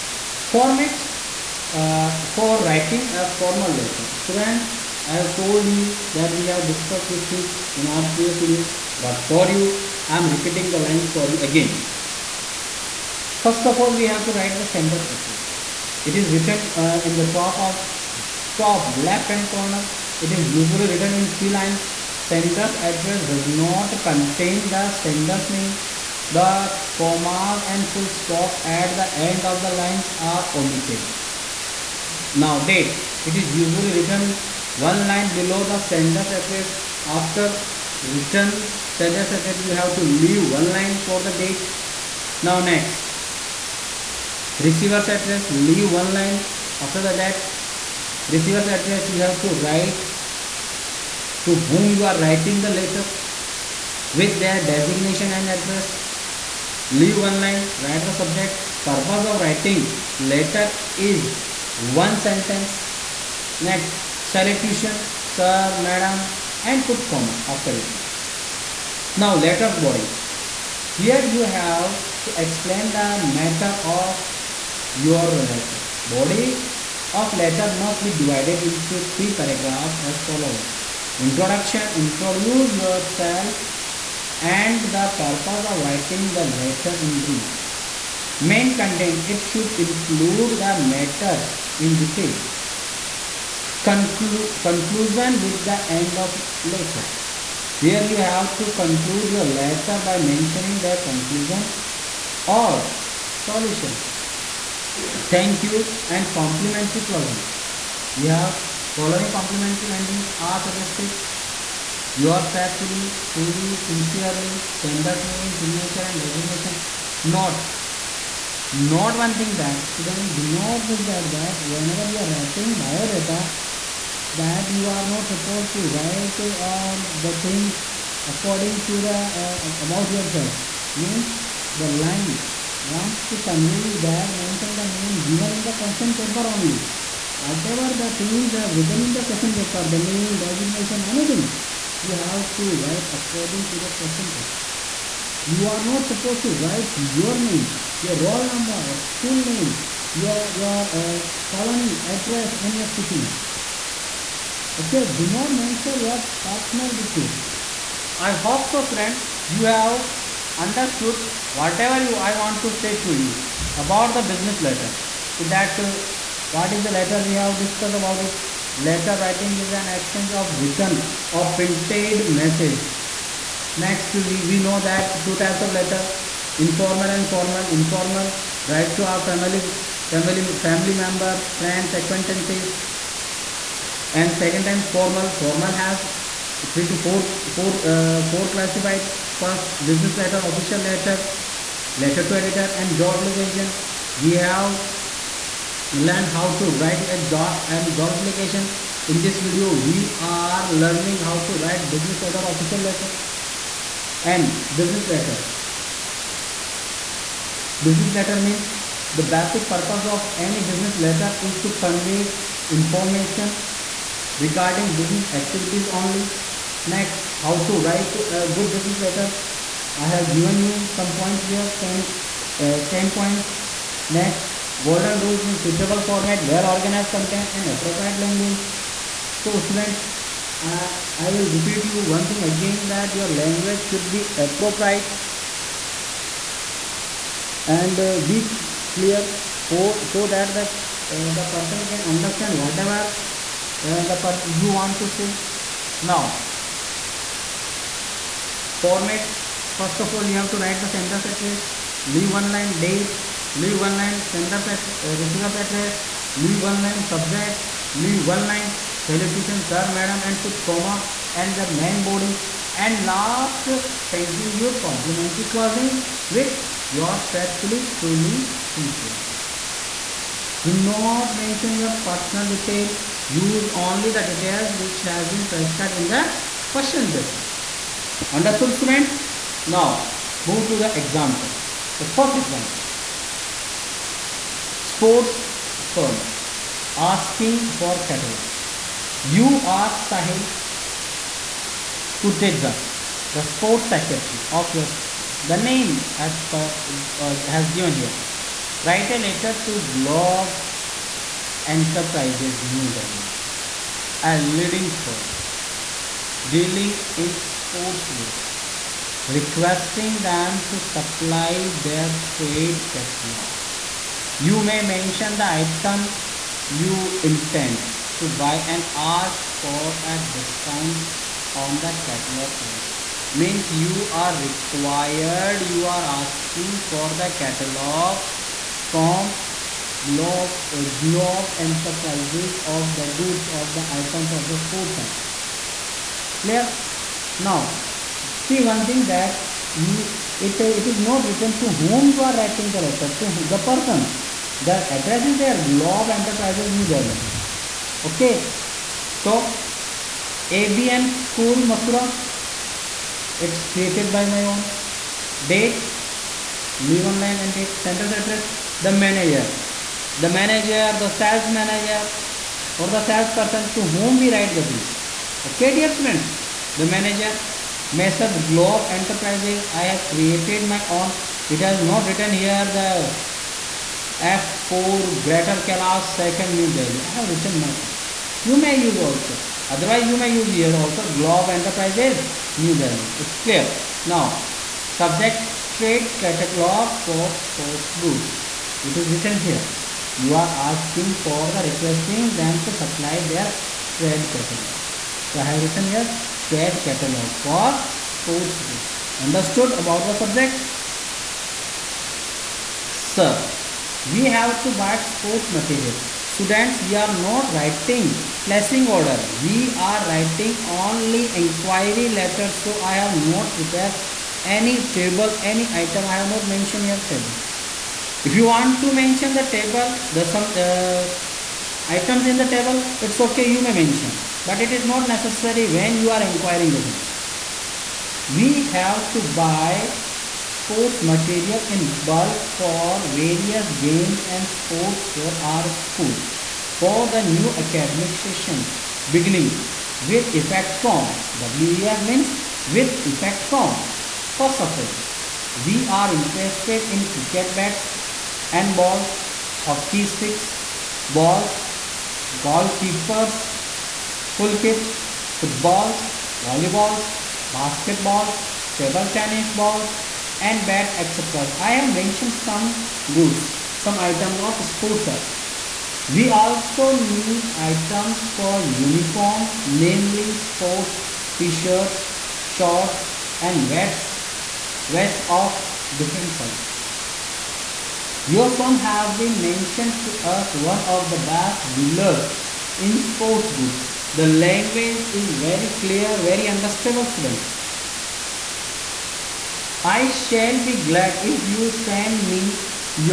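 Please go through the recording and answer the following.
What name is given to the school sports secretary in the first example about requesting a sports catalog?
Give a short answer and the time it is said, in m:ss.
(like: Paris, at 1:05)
Sahil Tutedza, at 4:49.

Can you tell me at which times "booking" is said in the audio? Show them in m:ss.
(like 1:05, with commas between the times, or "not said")
not said.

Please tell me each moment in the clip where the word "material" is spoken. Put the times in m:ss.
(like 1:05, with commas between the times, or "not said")
6:45, 7:11.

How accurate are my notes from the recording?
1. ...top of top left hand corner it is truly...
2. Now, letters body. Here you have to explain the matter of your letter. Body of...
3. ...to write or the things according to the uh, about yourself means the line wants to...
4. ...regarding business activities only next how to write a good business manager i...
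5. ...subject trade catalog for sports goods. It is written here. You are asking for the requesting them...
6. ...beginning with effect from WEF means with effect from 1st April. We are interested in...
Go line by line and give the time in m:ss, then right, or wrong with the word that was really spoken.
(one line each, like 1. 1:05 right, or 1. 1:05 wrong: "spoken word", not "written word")
1. 0:17 wrong: "usually", not "truly"
2. 1:09 right
3. 2:05 right
4. 3:34 wrong: "letter", not "manager"
5. 6:24 right
6. 7:19 right.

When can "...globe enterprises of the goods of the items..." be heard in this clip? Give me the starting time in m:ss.
5:31.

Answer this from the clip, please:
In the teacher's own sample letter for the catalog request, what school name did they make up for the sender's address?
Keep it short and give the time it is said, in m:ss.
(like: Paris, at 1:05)
ABM School Mathura, at 5:50.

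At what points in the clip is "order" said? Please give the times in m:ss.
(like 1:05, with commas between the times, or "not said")
6:48.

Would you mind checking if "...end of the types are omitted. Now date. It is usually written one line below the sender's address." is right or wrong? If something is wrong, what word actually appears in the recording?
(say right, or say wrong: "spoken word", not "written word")
wrong: "lines", not "types".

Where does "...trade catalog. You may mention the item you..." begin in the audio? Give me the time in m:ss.
5:12.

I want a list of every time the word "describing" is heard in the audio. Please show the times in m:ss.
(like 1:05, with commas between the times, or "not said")
not said.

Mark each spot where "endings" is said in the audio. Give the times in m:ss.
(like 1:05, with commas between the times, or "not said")
1:49.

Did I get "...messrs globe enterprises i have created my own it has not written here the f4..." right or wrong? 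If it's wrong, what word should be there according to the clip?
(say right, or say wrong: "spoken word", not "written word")
right.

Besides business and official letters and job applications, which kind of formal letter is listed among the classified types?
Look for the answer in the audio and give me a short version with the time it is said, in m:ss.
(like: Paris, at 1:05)
Letter to editor, at 3:11.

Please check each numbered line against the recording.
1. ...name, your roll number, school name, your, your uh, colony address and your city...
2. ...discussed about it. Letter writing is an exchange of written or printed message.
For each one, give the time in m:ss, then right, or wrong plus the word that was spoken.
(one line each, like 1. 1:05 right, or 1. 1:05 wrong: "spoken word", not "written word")
1. 2:27 right
2. 2:47 right.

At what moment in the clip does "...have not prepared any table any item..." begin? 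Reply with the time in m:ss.
6:52.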